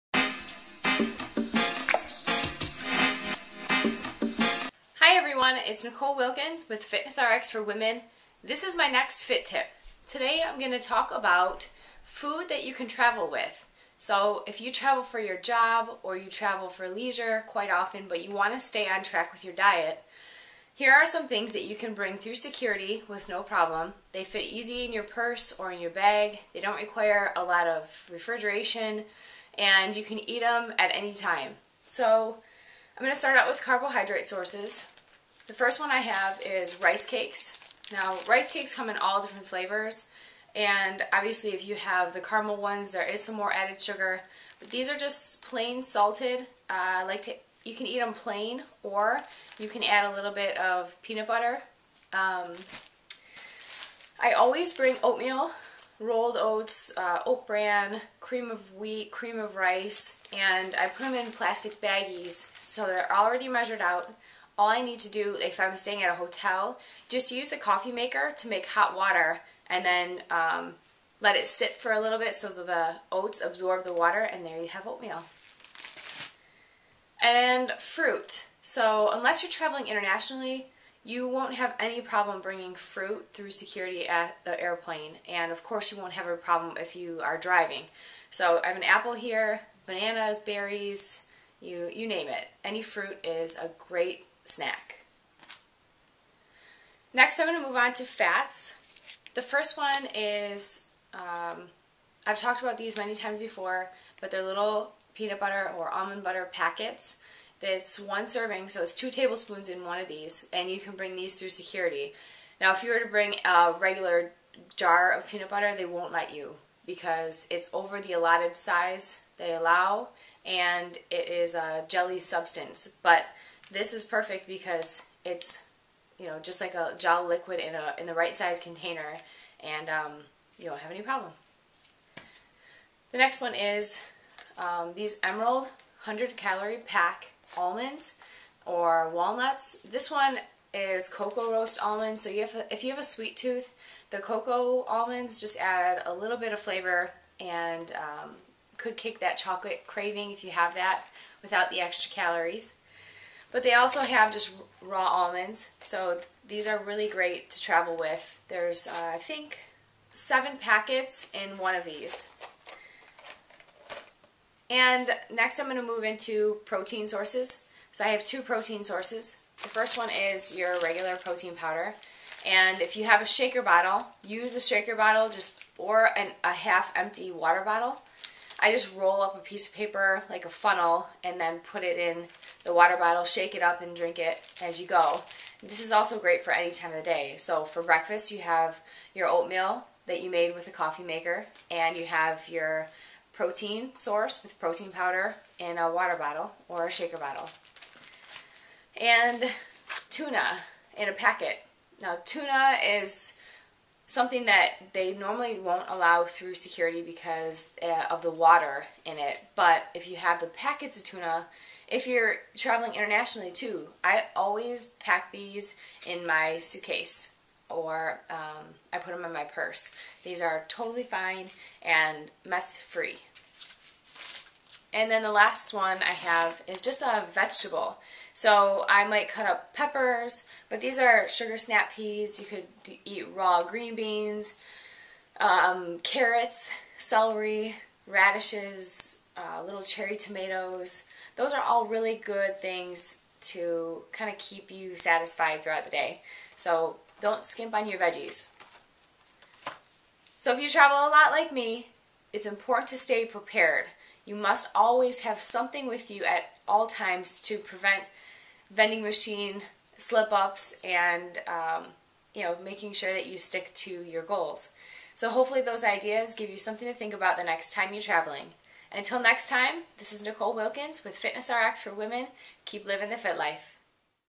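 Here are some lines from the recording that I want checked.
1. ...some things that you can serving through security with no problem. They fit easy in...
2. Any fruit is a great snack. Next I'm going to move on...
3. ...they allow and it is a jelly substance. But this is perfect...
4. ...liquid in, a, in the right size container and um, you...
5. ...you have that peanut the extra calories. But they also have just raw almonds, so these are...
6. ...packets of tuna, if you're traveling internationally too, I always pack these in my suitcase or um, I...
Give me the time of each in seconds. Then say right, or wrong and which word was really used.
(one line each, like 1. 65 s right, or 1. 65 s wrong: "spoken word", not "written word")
1. 21 s wrong: "bring", not "serving"
2. 92 s right
3. 119 s right
4. 127 s right
5. 150 s wrong: "without", not "peanut"
6. 210 s right.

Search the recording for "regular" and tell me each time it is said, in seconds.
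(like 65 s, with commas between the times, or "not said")
113 s, 170 s.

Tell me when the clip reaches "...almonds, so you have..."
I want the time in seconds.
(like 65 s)
141 s.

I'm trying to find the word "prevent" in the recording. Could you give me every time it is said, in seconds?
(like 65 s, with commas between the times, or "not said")
257 s.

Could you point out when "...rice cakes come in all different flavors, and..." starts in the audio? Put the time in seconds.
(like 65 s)
38 s.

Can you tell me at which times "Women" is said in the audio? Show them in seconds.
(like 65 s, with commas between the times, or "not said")
7 s, 271 s.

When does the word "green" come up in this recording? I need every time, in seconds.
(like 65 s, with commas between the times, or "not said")
233 s.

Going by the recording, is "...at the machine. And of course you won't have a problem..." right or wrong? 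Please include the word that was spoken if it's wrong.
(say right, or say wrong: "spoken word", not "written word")
wrong: "airplane", not "machine".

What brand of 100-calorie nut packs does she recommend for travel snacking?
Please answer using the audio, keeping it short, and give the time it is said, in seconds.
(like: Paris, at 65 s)
Emerald, at 135 s.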